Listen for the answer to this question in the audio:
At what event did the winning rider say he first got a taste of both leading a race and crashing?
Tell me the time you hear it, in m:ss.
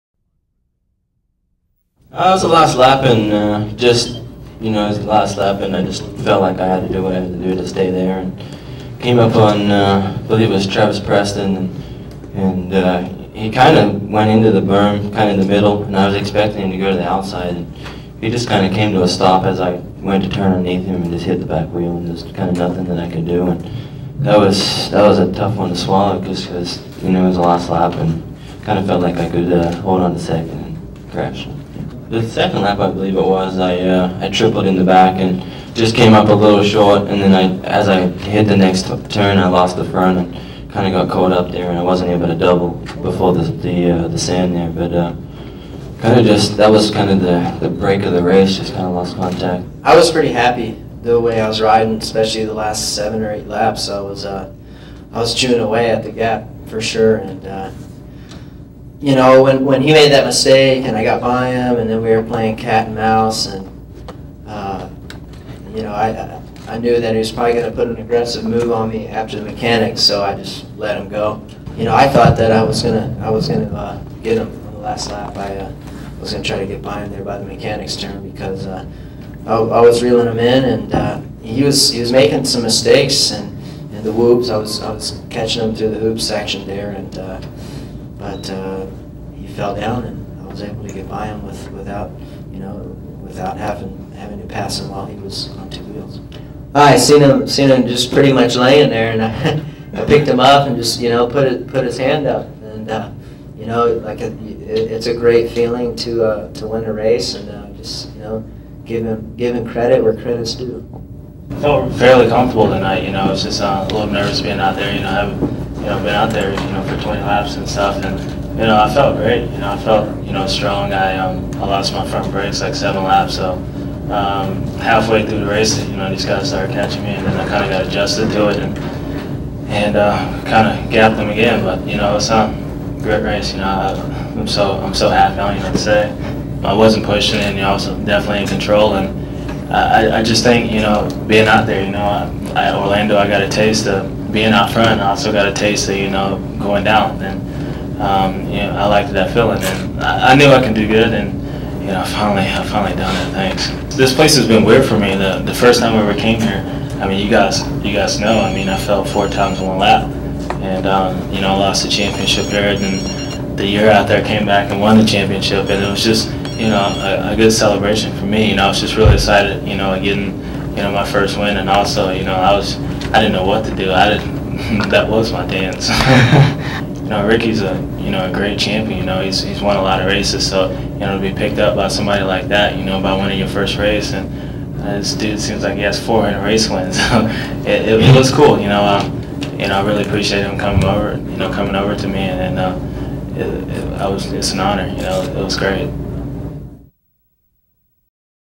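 2:22.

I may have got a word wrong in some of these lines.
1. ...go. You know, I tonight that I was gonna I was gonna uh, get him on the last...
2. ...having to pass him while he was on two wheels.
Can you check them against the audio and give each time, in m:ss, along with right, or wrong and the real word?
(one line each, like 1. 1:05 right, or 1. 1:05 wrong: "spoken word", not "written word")
1. 1:11 wrong: "thought", not "tonight"
2. 1:34 right.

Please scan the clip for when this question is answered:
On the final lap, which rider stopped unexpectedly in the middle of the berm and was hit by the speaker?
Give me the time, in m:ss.
0:10.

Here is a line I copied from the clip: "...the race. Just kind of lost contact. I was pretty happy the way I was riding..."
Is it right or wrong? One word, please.
right.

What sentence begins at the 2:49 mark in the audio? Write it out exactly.
You know getting you know my first win, and also you know I was I didn't know what to do.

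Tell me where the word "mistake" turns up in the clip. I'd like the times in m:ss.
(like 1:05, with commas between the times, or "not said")
1:00, 1:22.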